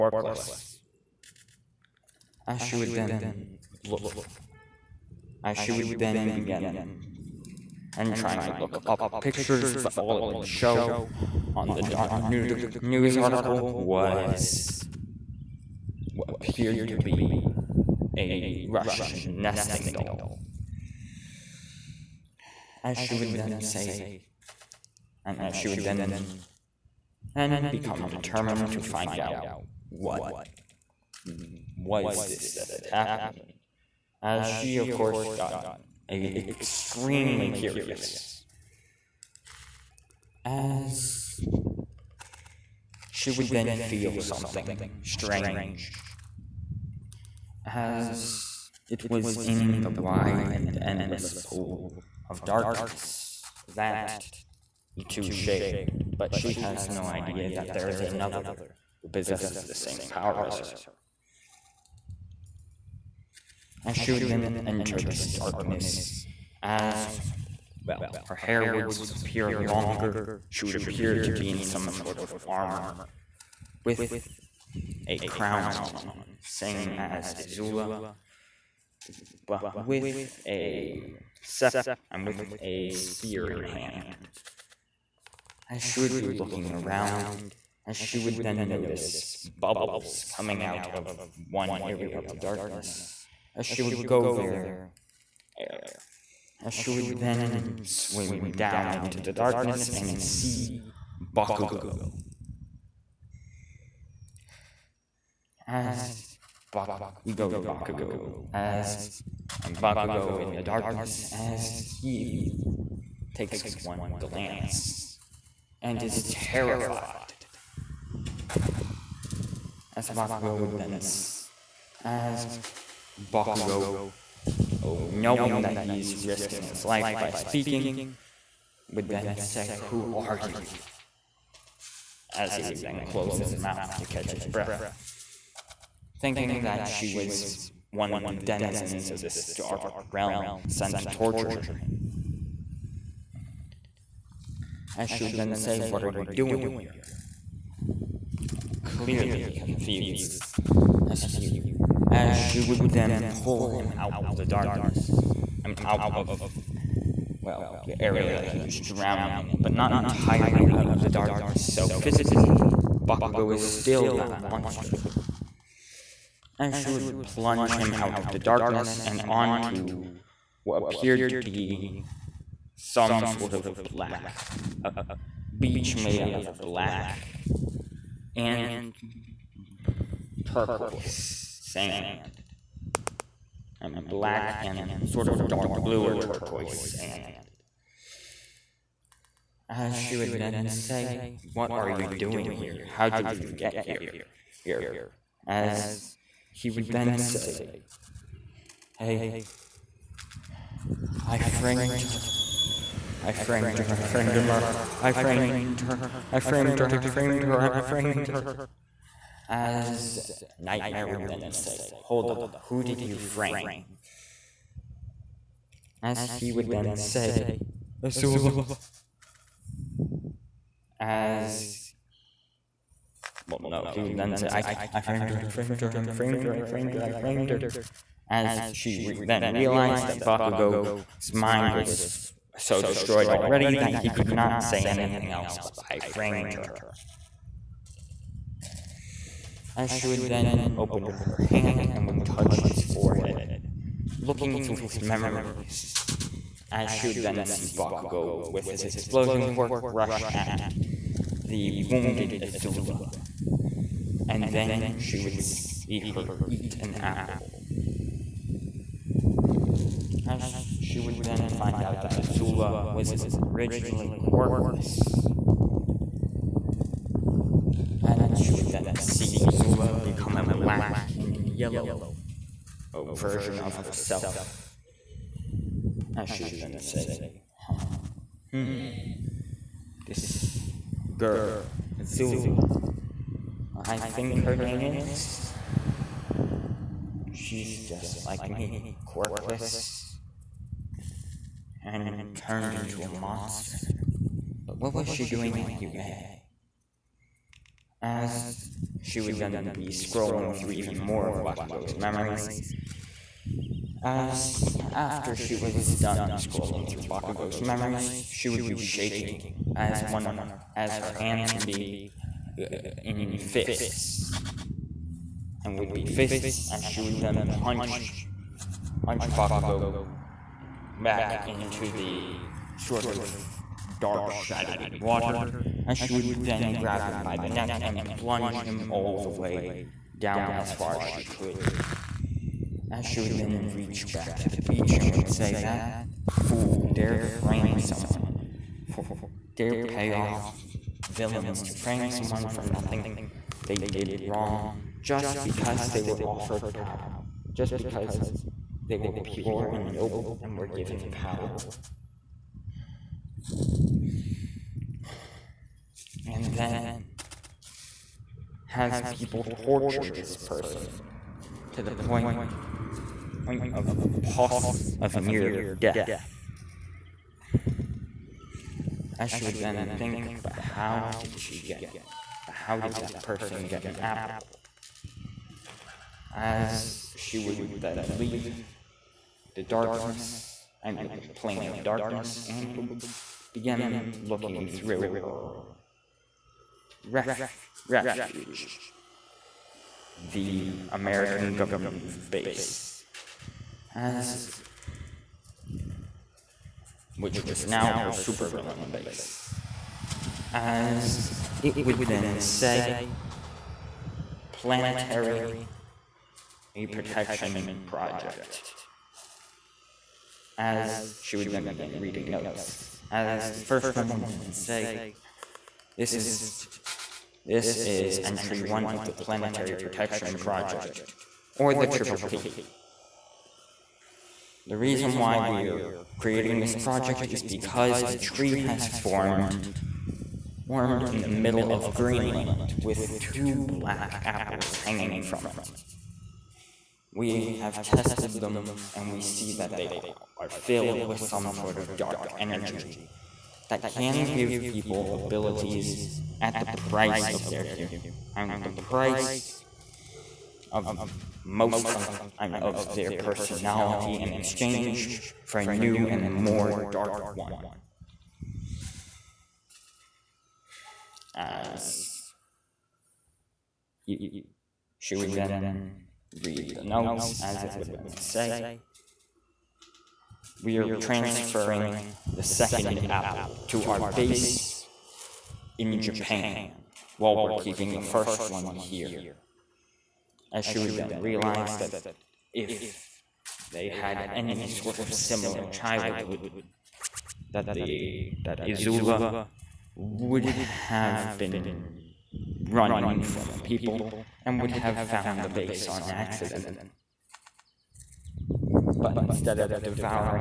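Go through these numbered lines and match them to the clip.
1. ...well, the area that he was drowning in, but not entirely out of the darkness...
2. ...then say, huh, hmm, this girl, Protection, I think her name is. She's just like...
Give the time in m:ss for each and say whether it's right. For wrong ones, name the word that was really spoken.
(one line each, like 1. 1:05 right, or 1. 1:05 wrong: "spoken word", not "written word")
1. 2:37 right
2. 4:36 wrong: "Azula", not "Protection".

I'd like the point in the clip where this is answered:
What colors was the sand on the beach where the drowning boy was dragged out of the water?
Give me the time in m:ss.
2:56.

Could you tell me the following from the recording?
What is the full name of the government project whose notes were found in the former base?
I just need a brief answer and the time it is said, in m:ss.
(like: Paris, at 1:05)
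Planetary Protection Project, at 6:59.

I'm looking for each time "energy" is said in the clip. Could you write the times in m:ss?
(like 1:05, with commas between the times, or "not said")
7:22.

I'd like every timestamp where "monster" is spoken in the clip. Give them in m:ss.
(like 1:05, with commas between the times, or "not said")
2:44, 4:53.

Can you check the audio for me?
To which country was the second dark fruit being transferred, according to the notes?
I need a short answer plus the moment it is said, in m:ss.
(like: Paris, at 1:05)
Japan, at 7:56.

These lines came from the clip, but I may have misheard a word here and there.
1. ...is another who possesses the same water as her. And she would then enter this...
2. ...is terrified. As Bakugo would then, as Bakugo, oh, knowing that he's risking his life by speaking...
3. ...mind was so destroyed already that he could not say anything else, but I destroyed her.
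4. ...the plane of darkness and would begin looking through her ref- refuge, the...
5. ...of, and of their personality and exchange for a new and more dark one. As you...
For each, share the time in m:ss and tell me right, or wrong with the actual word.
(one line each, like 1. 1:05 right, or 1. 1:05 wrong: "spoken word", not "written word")
1. 0:57 wrong: "power", not "water"
2. 1:56 right
3. 3:51 wrong: "framed", not "destroyed"
4. 6:21 right
5. 7:31 right.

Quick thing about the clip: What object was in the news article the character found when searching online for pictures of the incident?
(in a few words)
Russian nesting doll.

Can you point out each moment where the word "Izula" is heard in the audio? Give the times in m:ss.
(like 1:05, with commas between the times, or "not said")
8:08.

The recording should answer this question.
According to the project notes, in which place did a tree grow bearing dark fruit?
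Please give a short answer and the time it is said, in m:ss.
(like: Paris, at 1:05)
Greenland, at 7:11.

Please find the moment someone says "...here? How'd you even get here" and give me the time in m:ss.
3:12.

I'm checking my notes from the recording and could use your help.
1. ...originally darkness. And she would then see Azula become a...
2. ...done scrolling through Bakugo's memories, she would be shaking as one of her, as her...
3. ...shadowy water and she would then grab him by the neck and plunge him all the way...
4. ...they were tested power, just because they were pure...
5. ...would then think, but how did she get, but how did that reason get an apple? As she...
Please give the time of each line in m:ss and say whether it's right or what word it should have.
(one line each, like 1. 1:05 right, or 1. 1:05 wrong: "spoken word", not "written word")
1. 4:23 wrong: "quirkless", not "darkness"
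2. 5:05 right
3. 5:24 right
4. 5:45 wrong: "offered", not "tested"
5. 6:09 wrong: "person", not "reason".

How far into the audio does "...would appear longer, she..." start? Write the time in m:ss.
1:08.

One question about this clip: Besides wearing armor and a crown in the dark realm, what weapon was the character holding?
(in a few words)
A spear.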